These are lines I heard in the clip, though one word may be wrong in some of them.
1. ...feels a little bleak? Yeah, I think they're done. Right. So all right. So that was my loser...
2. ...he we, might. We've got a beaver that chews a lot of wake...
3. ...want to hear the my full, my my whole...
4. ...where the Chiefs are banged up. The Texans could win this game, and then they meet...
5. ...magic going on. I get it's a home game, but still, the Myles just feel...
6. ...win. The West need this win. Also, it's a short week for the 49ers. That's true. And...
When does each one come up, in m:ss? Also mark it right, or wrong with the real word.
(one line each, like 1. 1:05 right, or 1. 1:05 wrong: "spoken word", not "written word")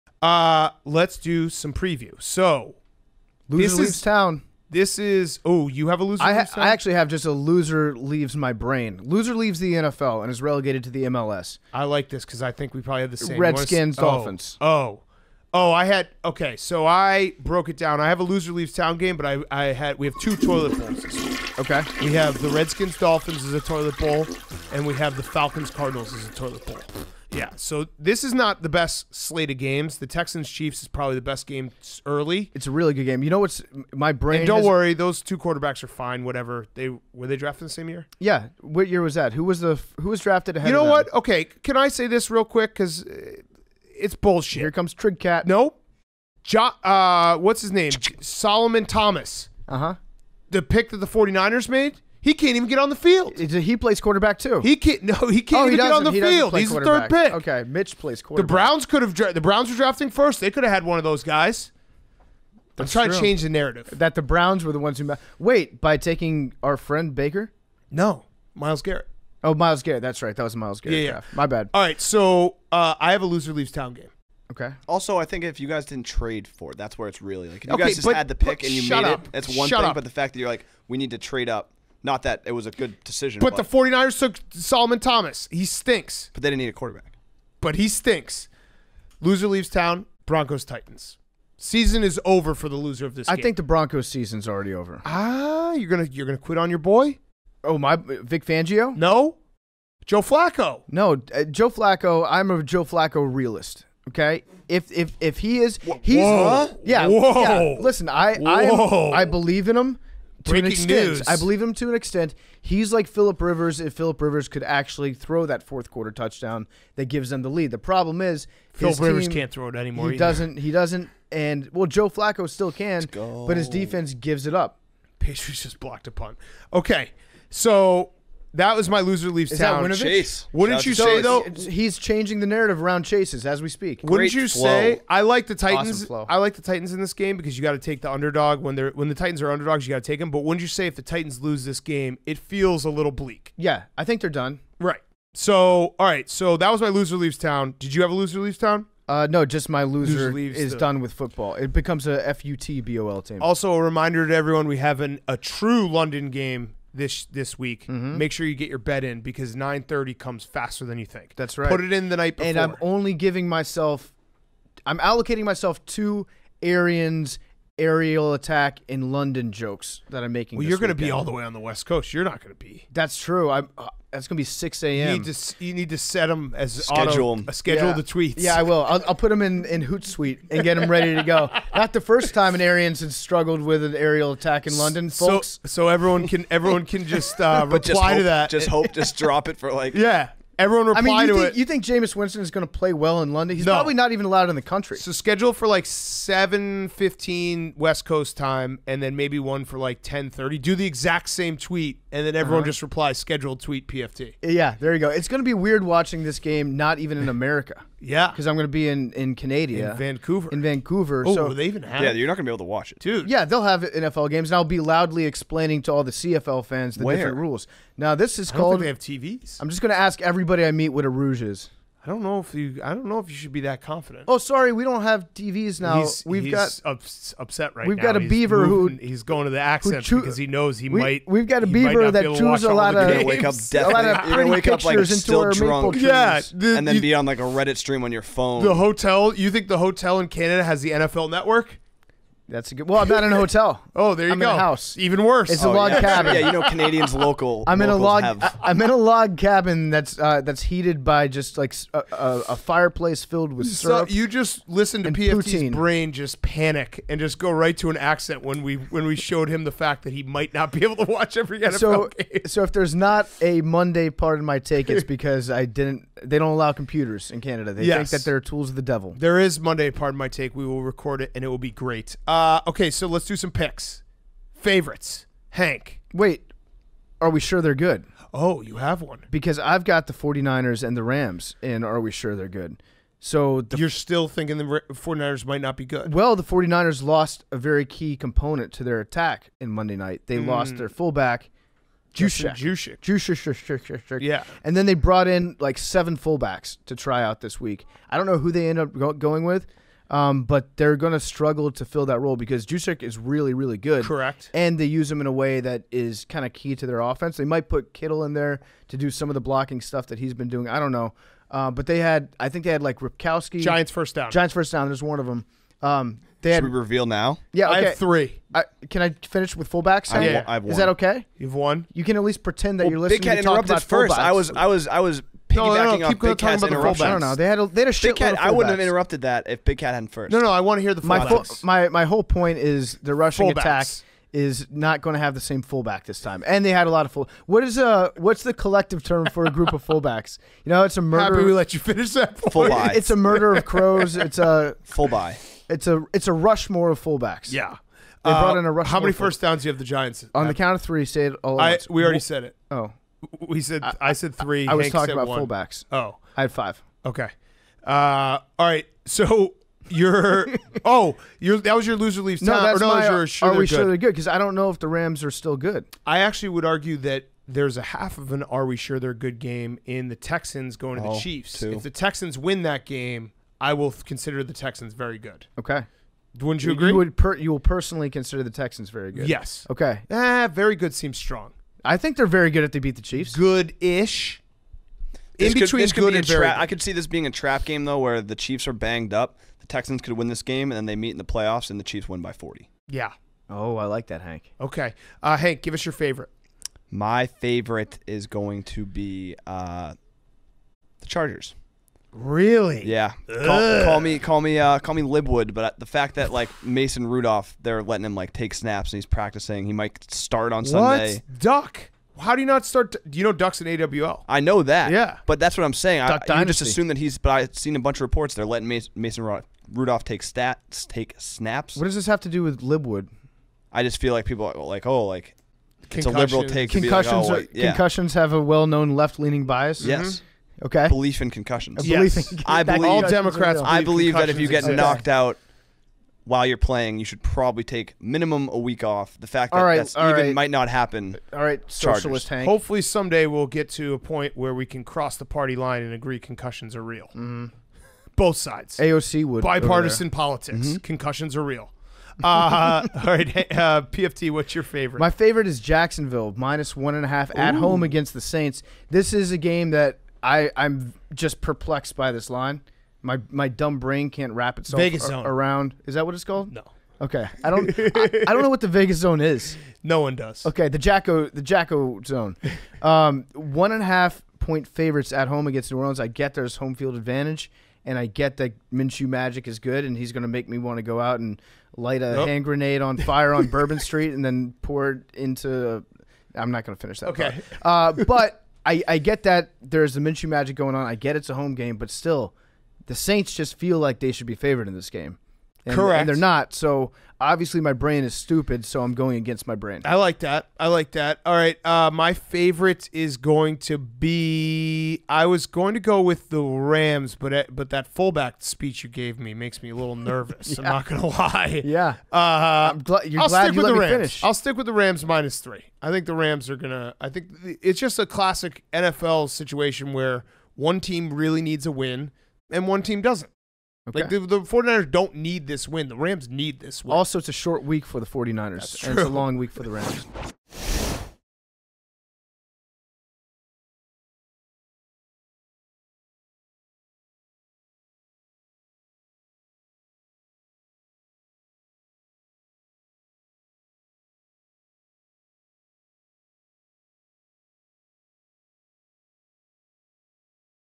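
1. 2:22 right
2. 3:50 right
3. 5:30 right
4. 6:27 right
5. 8:10 wrong: "Saints", not "Myles"
6. 8:45 wrong: "Rams", not "West".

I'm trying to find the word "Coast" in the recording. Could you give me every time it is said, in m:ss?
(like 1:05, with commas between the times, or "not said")
2:51, 3:18.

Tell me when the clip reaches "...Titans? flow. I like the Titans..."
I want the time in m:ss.
2:15.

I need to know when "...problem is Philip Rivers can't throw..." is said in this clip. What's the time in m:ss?
1:57.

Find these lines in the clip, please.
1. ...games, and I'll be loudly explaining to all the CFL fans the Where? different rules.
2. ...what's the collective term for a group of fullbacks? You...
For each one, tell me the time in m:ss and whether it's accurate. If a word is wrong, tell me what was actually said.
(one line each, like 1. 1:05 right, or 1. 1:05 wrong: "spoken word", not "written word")
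1. 3:34 right
2. 5:38 right.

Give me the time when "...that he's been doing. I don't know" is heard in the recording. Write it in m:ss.
5:10.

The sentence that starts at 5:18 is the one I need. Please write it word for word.
I, can I finish with fullbacks?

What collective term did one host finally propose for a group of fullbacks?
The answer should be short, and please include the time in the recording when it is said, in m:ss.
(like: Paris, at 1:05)
A Rushmore, at 5:46.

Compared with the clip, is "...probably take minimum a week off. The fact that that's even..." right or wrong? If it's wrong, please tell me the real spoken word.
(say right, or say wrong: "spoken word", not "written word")
right.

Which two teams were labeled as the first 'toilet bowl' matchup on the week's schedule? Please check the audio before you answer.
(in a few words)
Redskins, Dolphins.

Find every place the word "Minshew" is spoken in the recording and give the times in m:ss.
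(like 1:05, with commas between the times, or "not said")
7:58, 8:09.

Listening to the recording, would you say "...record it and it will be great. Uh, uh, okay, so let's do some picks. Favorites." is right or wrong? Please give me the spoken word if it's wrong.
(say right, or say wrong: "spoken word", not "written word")
right.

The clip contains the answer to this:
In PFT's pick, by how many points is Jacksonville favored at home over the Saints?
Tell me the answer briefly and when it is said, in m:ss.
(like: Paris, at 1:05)
1.5, at 7:36.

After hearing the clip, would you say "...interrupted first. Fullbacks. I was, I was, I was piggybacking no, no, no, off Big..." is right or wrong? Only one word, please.
right.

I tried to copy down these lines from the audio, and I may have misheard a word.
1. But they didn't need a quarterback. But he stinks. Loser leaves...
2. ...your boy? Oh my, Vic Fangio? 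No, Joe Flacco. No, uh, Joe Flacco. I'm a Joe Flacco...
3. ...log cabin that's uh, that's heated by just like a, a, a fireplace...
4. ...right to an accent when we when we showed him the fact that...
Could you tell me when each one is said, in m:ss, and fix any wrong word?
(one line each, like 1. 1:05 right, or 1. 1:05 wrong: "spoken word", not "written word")
1. 1:26 right
2. 1:36 right
3. 4:08 right
4. 4:17 right.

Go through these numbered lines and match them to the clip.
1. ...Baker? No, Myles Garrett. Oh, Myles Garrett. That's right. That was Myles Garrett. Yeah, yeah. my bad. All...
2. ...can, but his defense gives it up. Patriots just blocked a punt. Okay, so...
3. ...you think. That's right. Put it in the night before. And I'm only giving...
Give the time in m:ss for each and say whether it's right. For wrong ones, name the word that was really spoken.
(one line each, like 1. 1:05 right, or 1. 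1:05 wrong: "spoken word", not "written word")
1. 1:07 right
2. 2:02 right
3. 2:40 right.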